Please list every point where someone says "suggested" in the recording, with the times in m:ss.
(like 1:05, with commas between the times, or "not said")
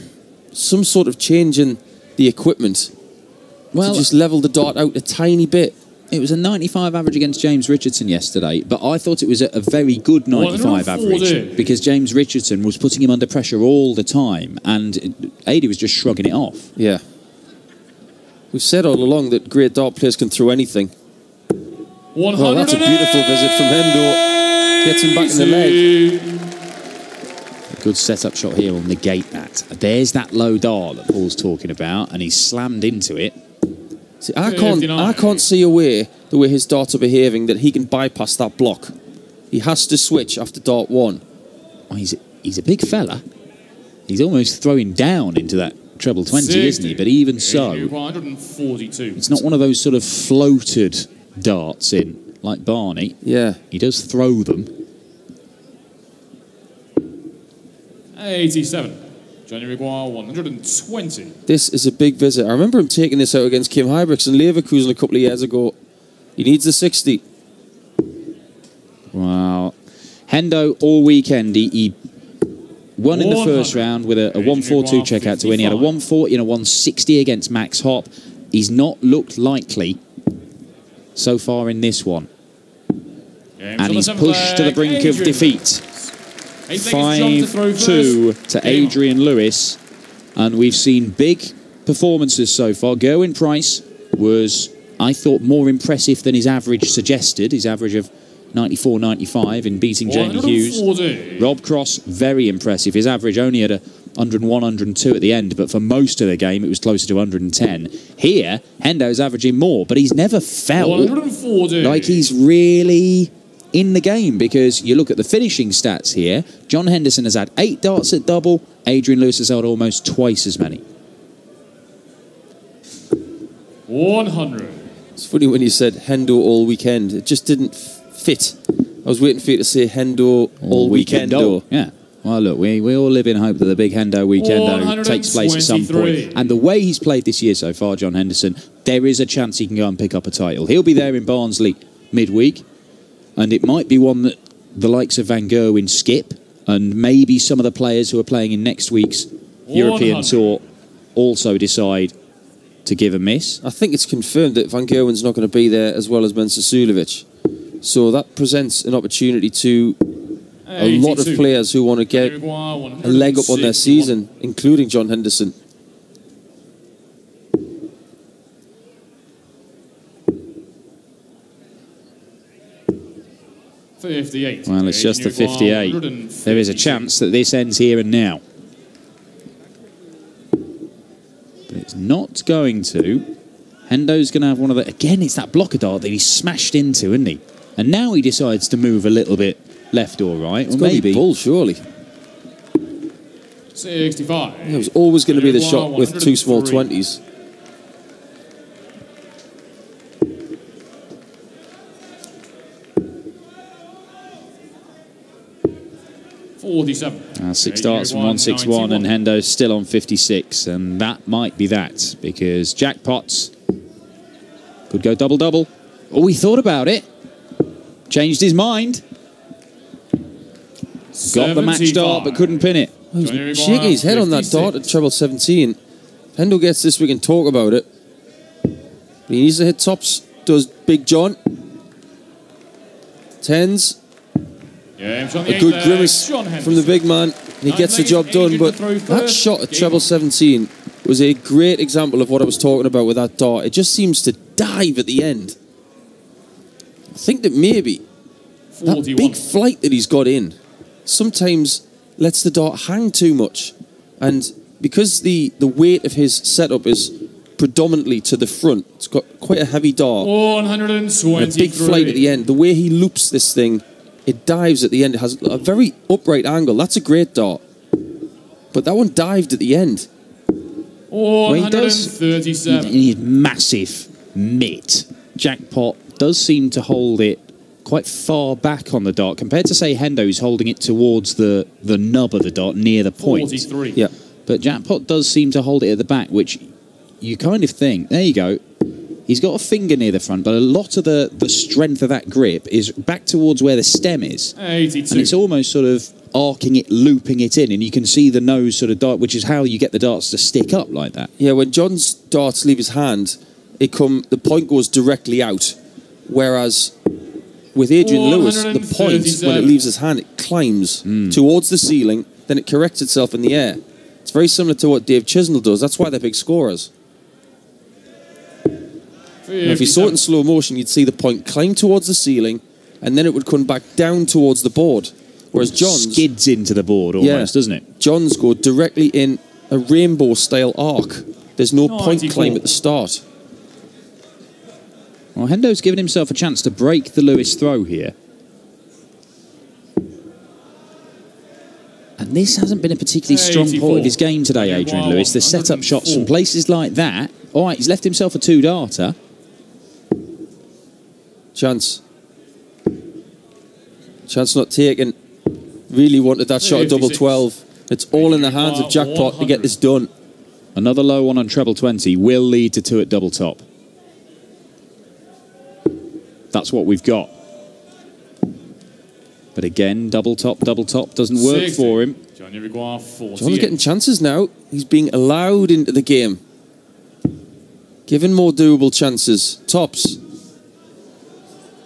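1:36.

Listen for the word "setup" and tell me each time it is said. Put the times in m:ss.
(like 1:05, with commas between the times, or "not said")
0:27, 4:16, 5:45.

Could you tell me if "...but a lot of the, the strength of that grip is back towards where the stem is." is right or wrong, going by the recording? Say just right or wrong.
right.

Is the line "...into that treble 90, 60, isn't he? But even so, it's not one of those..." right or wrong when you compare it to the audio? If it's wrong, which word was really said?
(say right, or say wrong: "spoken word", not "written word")
wrong: "20", not "90".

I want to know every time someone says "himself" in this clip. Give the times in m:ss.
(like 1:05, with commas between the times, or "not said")
5:35, 5:48.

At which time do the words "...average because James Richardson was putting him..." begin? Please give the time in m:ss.
0:10.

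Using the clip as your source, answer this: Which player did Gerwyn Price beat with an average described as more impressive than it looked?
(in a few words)
Jamie Hughes.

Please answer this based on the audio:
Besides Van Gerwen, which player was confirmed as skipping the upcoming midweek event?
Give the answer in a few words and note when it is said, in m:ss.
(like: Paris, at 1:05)
Mensur Suljovic, at 2:36.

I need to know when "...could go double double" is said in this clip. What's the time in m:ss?
3:34.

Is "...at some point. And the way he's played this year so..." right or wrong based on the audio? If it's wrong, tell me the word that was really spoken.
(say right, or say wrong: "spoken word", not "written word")
right.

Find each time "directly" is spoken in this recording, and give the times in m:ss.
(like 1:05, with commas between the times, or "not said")
5:04, 5:28.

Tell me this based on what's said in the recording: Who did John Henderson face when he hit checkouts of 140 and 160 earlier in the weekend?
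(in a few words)
Max Hopp.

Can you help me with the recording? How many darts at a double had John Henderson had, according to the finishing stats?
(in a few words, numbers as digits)
8.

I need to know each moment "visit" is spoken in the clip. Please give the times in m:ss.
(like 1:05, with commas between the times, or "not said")
0:23, 1:02.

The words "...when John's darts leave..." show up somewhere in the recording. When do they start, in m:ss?
5:01.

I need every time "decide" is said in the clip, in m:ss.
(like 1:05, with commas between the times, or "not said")
2:31, 3:08.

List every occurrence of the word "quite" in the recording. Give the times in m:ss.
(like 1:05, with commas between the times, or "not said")
4:19, 4:37.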